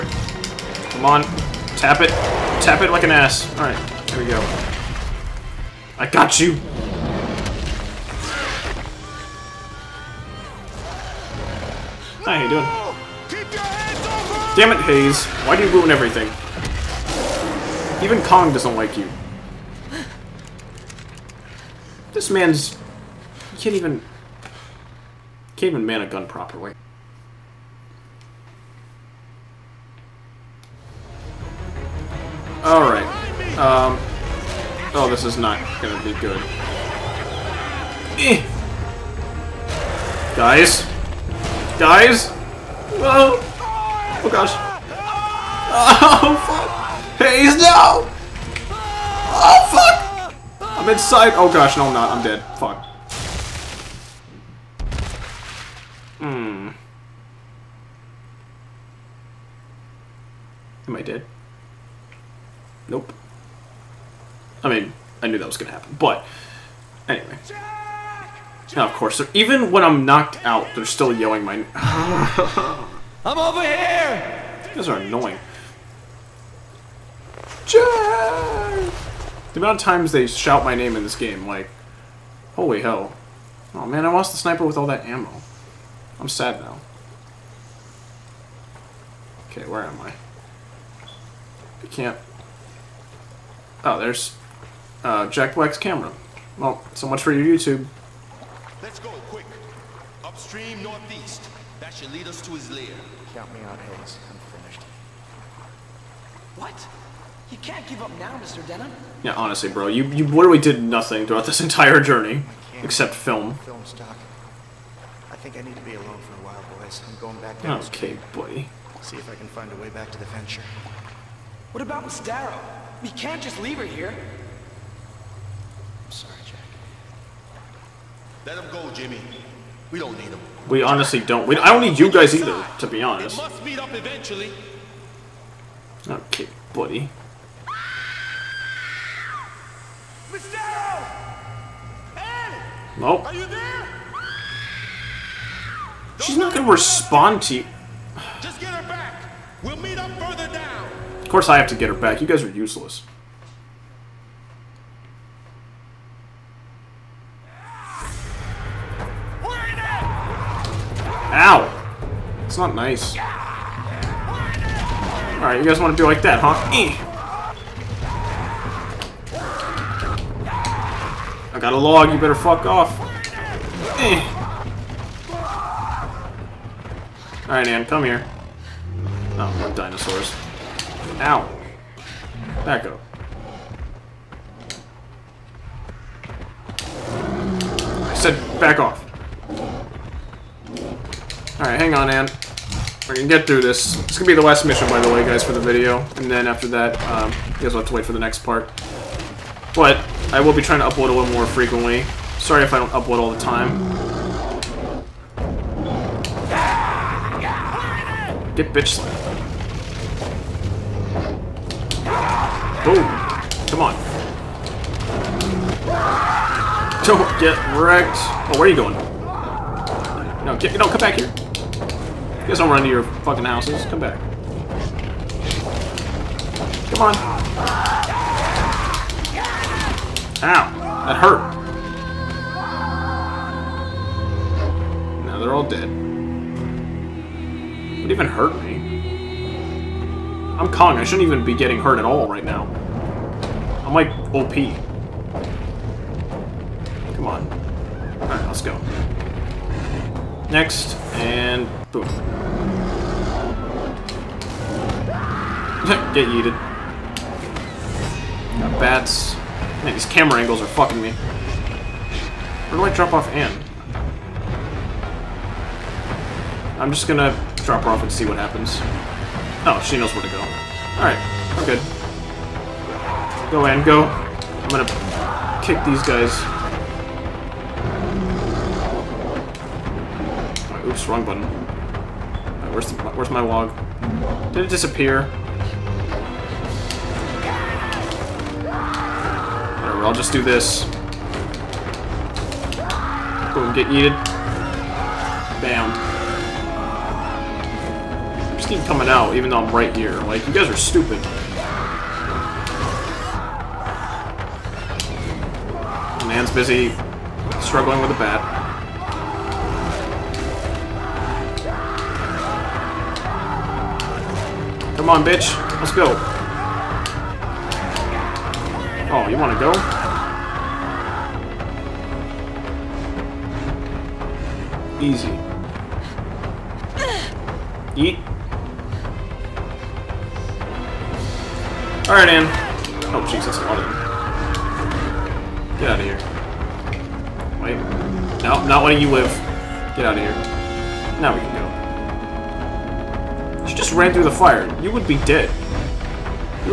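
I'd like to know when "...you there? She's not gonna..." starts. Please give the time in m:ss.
2:23.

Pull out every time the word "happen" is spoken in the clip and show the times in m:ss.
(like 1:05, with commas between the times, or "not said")
1:05, 4:28.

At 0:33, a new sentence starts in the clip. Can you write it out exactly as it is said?
Um, oh, this is not gonna be good.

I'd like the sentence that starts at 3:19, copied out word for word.
But I will be trying to upload a little more frequently.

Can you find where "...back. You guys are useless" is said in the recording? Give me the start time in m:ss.
2:31.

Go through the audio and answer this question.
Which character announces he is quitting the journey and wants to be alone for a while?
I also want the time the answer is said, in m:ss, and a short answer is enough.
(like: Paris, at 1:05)
Mr. Denham, at 1:48.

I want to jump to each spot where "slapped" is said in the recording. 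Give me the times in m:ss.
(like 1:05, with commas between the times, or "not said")
3:28.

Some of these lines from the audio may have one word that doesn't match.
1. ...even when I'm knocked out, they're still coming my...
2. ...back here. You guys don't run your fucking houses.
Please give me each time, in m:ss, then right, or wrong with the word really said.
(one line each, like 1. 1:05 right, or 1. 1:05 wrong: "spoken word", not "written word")
1. 1:09 wrong: "yelling", not "coming"
2. 3:40 right.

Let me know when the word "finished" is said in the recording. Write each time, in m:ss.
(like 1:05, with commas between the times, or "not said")
1:44.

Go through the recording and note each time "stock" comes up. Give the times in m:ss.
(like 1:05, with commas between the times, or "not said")
1:53.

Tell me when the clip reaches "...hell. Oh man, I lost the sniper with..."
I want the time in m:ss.
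1:22.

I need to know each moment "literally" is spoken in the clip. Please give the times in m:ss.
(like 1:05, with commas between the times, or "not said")
1:50.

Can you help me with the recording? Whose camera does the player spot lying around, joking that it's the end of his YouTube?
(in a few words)
Jack Black.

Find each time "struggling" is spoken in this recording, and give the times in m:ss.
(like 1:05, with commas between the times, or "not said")
5:07.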